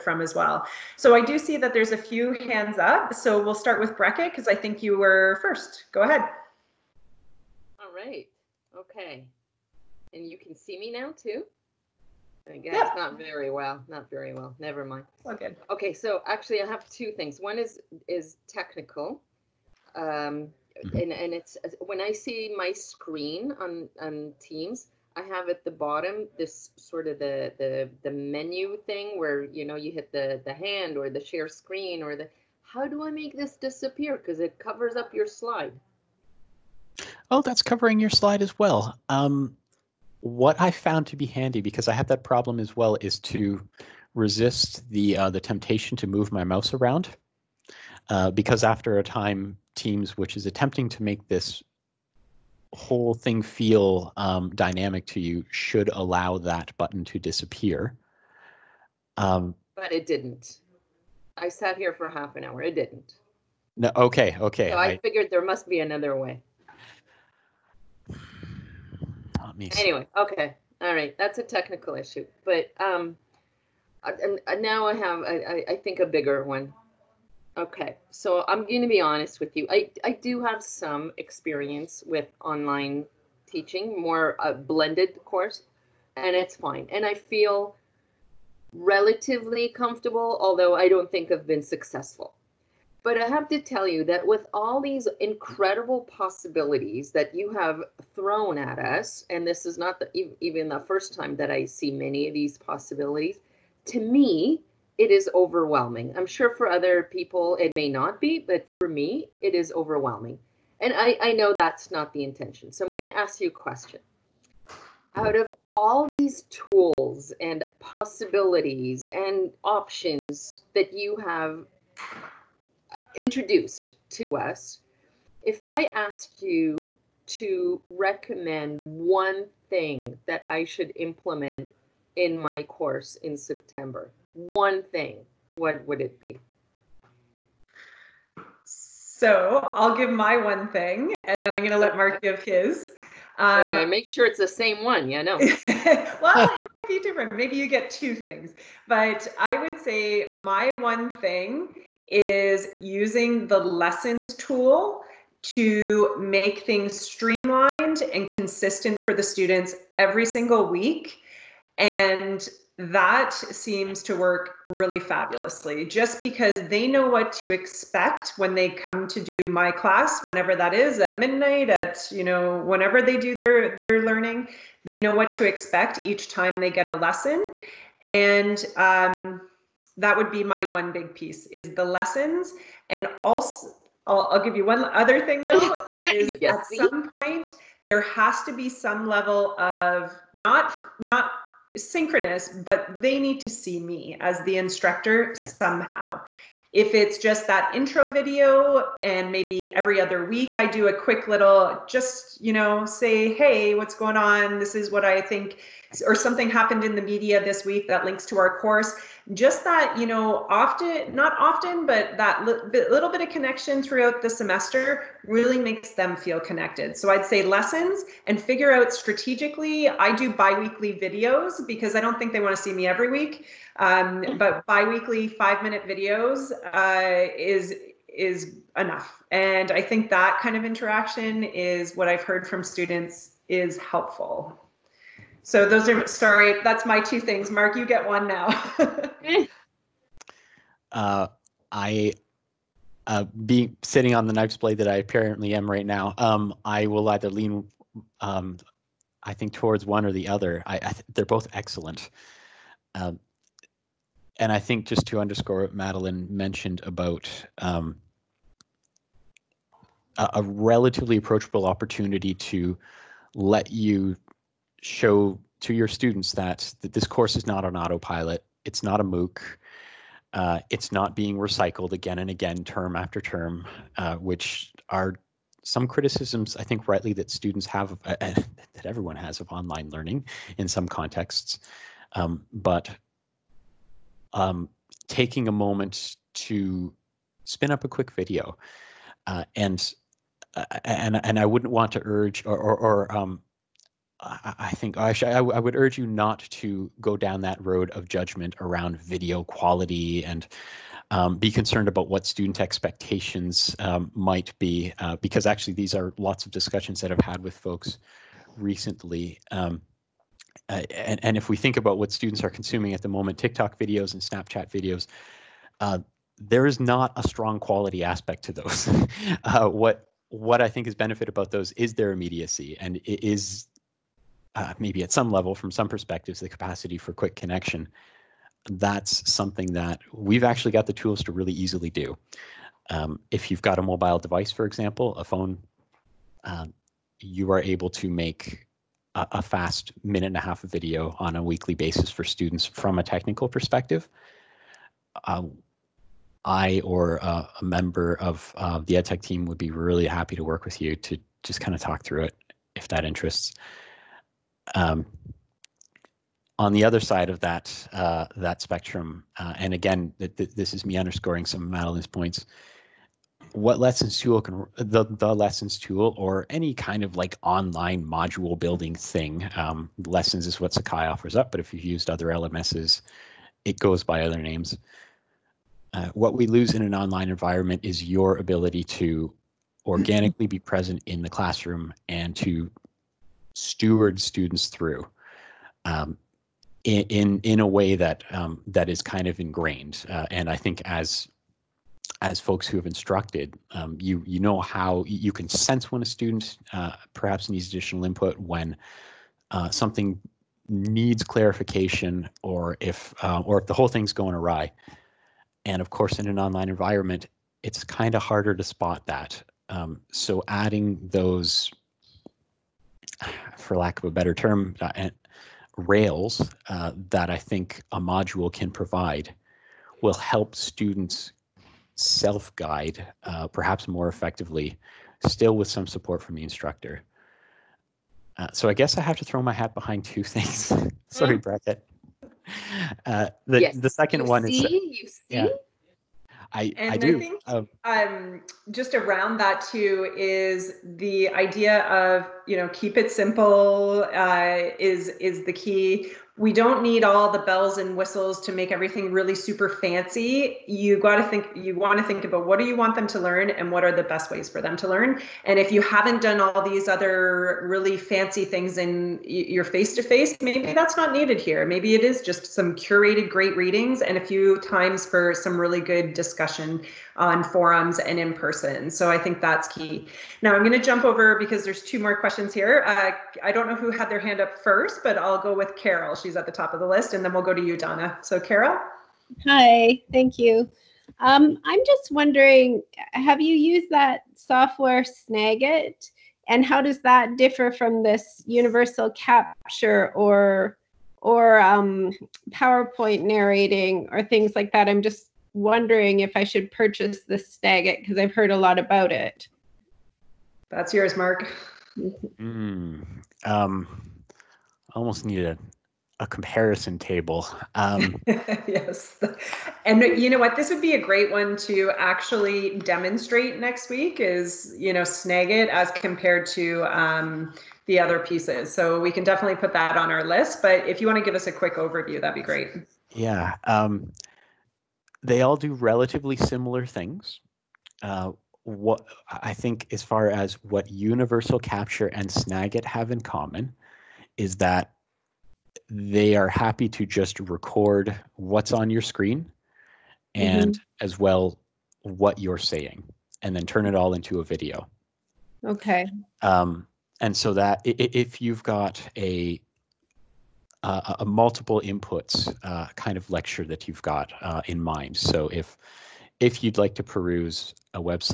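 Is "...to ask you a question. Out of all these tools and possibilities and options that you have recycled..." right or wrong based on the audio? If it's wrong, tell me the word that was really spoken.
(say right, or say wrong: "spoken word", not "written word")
wrong: "introduced", not "recycled".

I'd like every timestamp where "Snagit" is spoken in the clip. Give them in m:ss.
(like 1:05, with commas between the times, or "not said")
8:05, 8:17, 8:35, 8:52.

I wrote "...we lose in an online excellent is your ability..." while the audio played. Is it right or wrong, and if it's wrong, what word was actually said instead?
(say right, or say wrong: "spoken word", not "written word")
wrong: "environment", not "excellent".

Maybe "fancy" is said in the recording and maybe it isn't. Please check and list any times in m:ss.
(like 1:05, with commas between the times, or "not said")
7:29, 7:37.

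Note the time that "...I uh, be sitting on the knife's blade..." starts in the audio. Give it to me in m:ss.
4:01.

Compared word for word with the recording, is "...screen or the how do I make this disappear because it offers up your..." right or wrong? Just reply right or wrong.
wrong.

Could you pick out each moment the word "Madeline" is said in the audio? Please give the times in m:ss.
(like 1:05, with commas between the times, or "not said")
4:15, 6:01.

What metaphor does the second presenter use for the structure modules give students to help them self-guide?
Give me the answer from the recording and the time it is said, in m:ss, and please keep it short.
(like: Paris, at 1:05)
Rails, at 6:55.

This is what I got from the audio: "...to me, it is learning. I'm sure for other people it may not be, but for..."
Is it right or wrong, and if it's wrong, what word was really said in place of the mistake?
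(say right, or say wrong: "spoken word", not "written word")
wrong: "overwhelming", not "learning".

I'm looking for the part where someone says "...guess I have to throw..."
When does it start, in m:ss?
7:08.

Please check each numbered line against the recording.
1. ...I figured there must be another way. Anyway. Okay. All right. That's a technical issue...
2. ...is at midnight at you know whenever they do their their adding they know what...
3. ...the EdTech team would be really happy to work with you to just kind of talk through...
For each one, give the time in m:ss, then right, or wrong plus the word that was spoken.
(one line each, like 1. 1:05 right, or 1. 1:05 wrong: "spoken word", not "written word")
1. 1:04 right
2. 2:50 wrong: "learning", not "adding"
3. 5:48 right.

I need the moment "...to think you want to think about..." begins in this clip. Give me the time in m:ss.
7:31.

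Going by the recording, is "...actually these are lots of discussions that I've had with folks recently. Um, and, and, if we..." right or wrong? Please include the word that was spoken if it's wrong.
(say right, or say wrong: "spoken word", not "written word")
right.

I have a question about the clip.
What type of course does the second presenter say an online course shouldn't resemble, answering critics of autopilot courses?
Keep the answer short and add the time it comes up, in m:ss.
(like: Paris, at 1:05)
MOOC, at 4:29.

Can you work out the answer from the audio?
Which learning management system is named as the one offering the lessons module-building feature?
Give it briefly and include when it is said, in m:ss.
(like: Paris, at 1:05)
Sakai, at 6:10.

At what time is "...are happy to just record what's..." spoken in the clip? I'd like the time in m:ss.
8:56.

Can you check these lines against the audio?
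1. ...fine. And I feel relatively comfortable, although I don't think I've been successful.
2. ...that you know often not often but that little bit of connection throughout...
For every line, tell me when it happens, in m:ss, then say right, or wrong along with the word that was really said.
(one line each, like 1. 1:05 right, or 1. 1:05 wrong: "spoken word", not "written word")
1. 1:26 right
2. 3:29 right.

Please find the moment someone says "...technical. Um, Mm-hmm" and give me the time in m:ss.
0:18.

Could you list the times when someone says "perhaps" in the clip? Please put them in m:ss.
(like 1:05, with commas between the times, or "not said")
6:37, 7:03.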